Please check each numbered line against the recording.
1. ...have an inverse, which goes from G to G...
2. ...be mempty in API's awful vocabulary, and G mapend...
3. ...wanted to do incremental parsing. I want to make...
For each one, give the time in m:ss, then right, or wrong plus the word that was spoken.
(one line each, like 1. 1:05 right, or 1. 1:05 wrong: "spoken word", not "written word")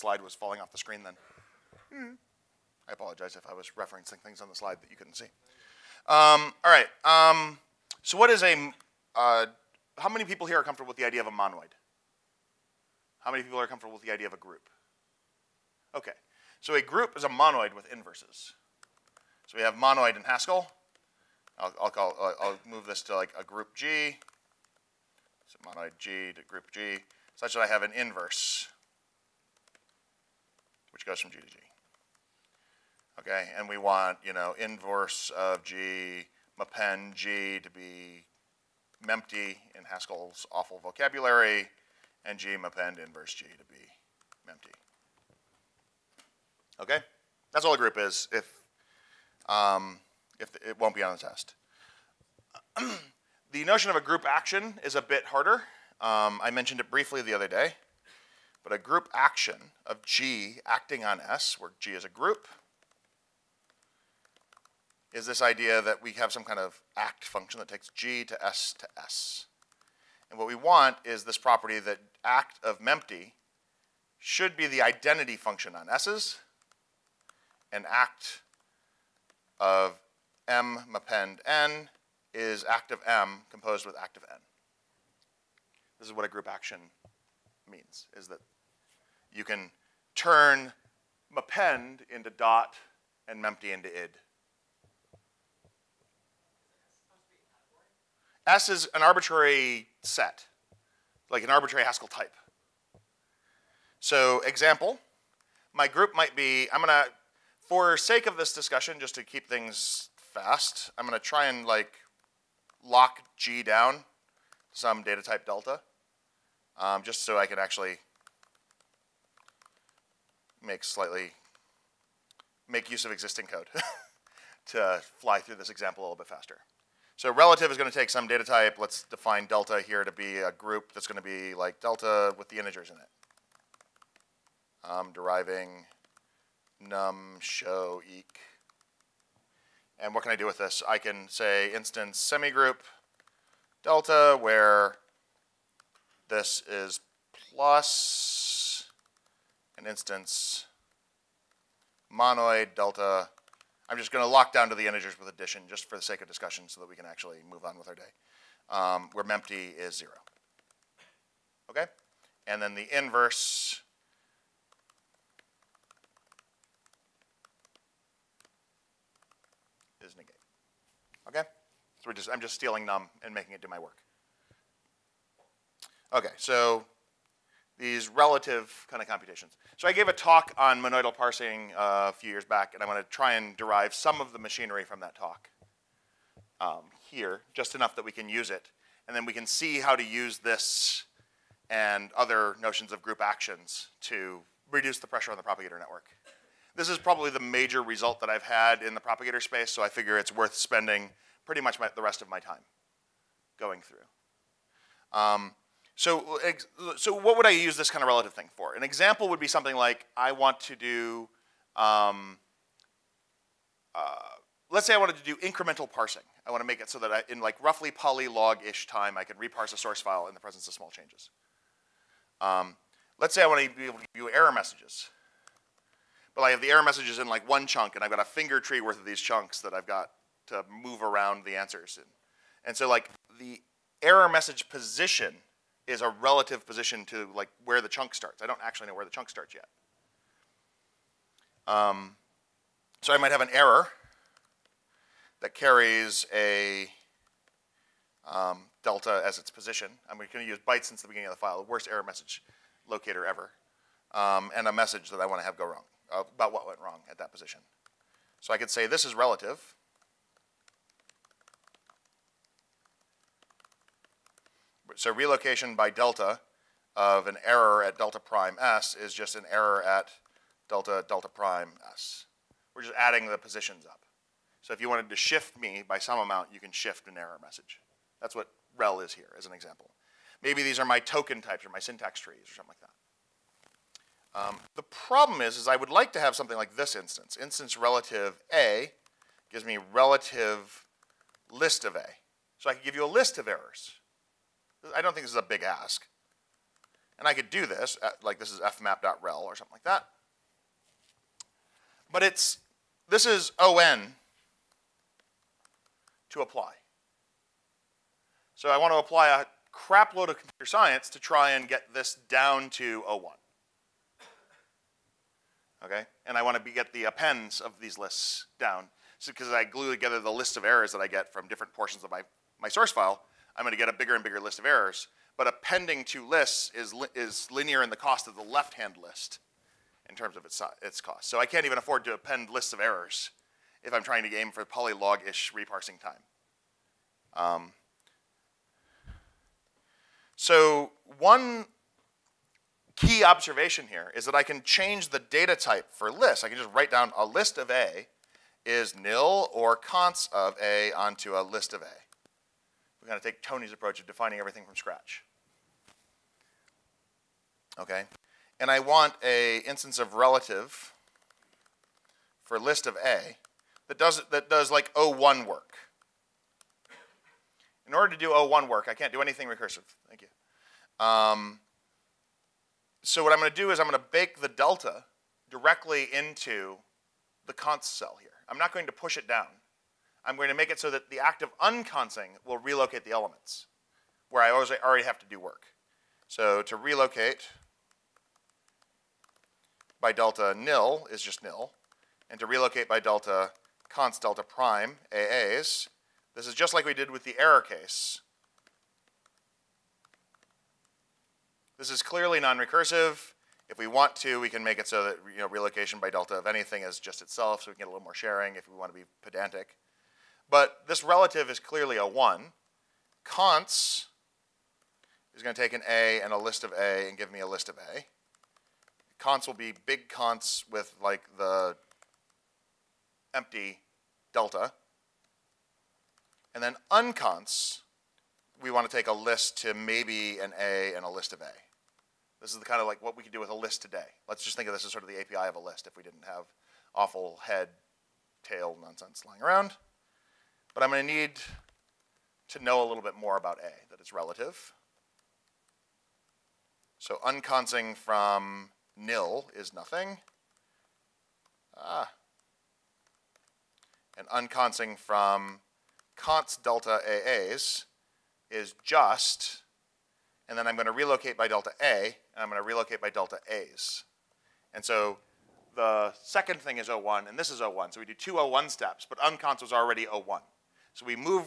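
1. 0:27 right
2. 0:37 wrong: "Haskell", not "API"
3. 3:34 right.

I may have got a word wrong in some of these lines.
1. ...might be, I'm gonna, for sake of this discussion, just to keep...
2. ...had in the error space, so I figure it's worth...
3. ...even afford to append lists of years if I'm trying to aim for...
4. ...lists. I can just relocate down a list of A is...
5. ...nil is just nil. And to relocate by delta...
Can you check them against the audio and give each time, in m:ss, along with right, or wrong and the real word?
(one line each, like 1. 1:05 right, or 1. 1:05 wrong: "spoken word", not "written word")
1. 1:46 right
2. 3:18 wrong: "propagator", not "error"
3. 5:31 wrong: "errors", not "years"
4. 5:46 wrong: "write", not "relocate"
5. 6:30 right.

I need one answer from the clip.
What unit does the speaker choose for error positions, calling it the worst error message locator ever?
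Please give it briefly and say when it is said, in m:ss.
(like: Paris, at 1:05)
bytes, at 4:10.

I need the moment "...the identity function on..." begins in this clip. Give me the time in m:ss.
1:14.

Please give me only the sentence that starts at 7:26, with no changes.
So unconsing from nil is nothing.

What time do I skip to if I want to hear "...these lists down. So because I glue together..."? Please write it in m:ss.
5:17.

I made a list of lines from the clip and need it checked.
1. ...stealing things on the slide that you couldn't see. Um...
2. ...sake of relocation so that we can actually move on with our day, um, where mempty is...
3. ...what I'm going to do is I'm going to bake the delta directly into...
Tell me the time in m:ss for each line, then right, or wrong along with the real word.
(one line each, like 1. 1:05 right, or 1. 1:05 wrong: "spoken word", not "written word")
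1. 0:03 wrong: "referencing", not "stealing"
2. 2:36 wrong: "discussion", not "relocation"
3. 6:13 right.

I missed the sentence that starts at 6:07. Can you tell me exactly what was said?
In order to do O1 work, I can't do anything recursive.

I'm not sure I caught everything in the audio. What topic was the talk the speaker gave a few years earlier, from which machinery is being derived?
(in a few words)
monoidal parsing.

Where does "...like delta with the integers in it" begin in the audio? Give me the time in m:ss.
2:11.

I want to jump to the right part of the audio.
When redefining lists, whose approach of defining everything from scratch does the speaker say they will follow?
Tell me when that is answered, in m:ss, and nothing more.
5:53.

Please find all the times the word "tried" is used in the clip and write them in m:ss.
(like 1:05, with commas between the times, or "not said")
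not said.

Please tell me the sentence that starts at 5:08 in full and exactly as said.
So I want to apply a crap load of computer science to try and get this down to 01.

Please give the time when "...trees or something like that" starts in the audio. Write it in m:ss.
4:42.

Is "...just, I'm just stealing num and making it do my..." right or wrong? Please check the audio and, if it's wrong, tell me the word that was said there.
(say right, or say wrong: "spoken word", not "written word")
right.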